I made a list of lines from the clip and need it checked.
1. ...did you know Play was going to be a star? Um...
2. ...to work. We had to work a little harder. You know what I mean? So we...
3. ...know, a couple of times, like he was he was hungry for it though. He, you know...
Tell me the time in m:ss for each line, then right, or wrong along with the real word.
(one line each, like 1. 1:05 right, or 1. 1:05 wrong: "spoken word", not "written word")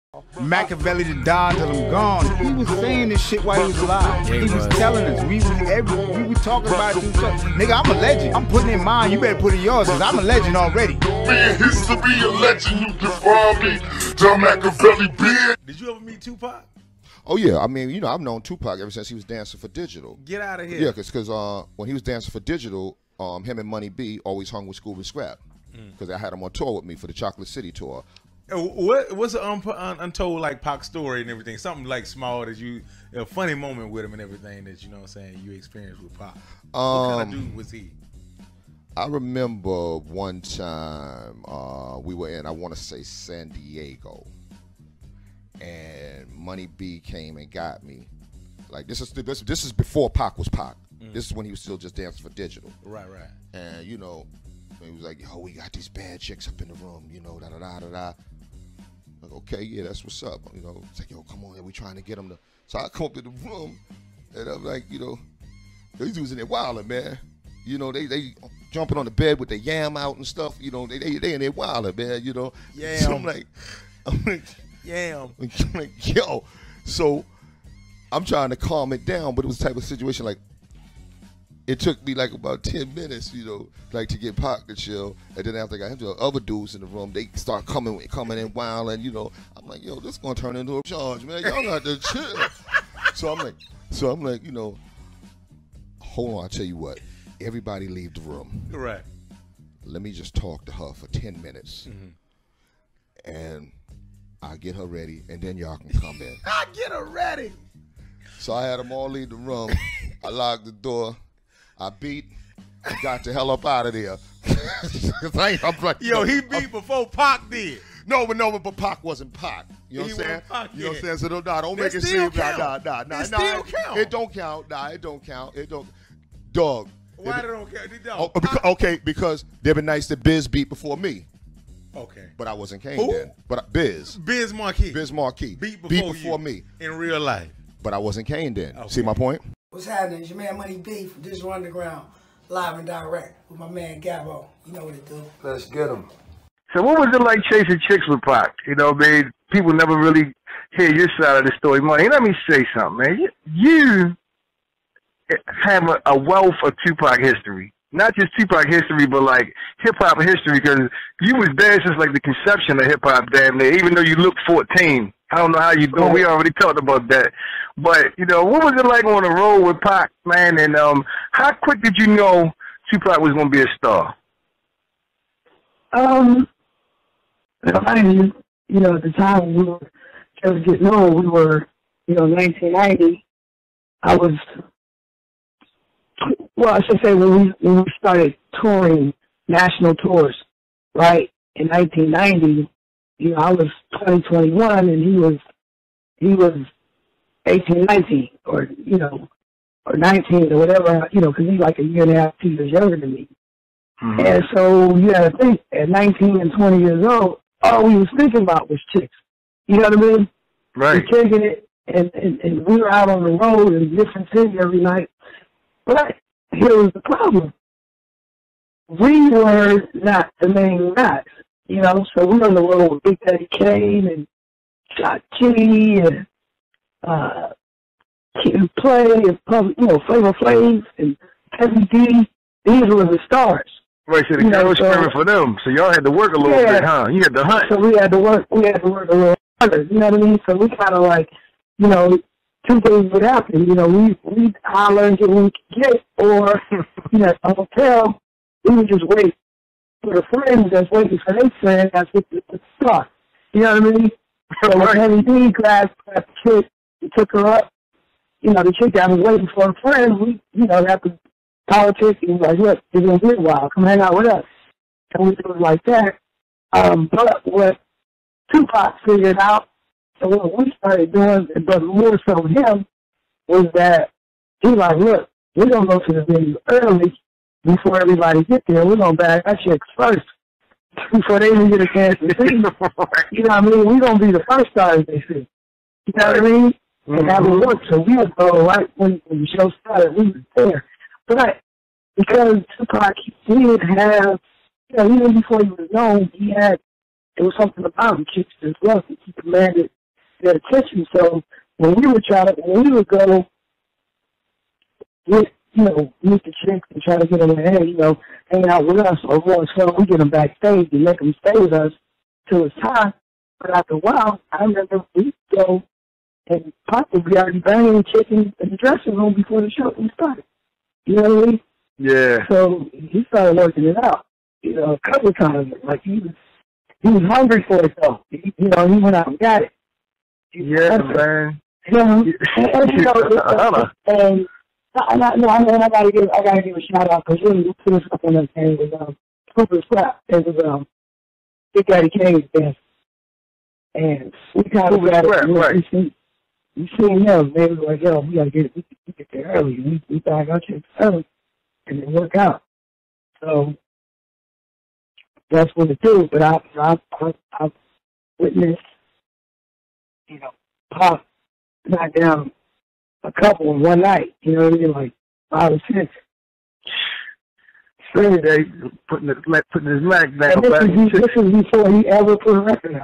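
1. 2:51 wrong: "Tupac", not "Play"
2. 3:58 right
3. 5:24 right.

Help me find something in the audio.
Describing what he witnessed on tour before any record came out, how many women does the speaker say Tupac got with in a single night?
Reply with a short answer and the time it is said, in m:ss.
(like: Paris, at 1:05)
5 or 6, at 6:05.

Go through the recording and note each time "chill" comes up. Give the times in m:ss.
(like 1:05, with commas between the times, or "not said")
1:24, 1:31.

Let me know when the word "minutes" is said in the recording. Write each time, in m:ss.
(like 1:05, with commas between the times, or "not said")
1:22, 1:41.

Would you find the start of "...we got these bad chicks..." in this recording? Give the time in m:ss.
0:55.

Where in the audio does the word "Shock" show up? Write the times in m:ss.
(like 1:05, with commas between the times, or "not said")
3:44.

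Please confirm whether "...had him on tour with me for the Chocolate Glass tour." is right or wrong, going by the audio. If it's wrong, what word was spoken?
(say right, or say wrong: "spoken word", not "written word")
wrong: "City", not "Glass".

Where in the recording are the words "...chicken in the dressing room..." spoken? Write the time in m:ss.
5:18.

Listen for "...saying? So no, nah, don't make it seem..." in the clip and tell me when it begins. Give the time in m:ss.
2:01.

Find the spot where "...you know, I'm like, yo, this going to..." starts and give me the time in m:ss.
1:29.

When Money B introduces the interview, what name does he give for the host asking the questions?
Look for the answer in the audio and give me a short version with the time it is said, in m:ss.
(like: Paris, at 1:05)
Gabo, at 2:24.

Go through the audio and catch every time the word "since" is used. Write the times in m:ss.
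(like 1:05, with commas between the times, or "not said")
0:18, 2:41.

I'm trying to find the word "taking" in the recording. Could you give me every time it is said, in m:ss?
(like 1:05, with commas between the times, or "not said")
3:31.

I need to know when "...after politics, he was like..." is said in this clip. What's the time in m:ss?
4:20.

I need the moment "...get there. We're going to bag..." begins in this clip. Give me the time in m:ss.
4:38.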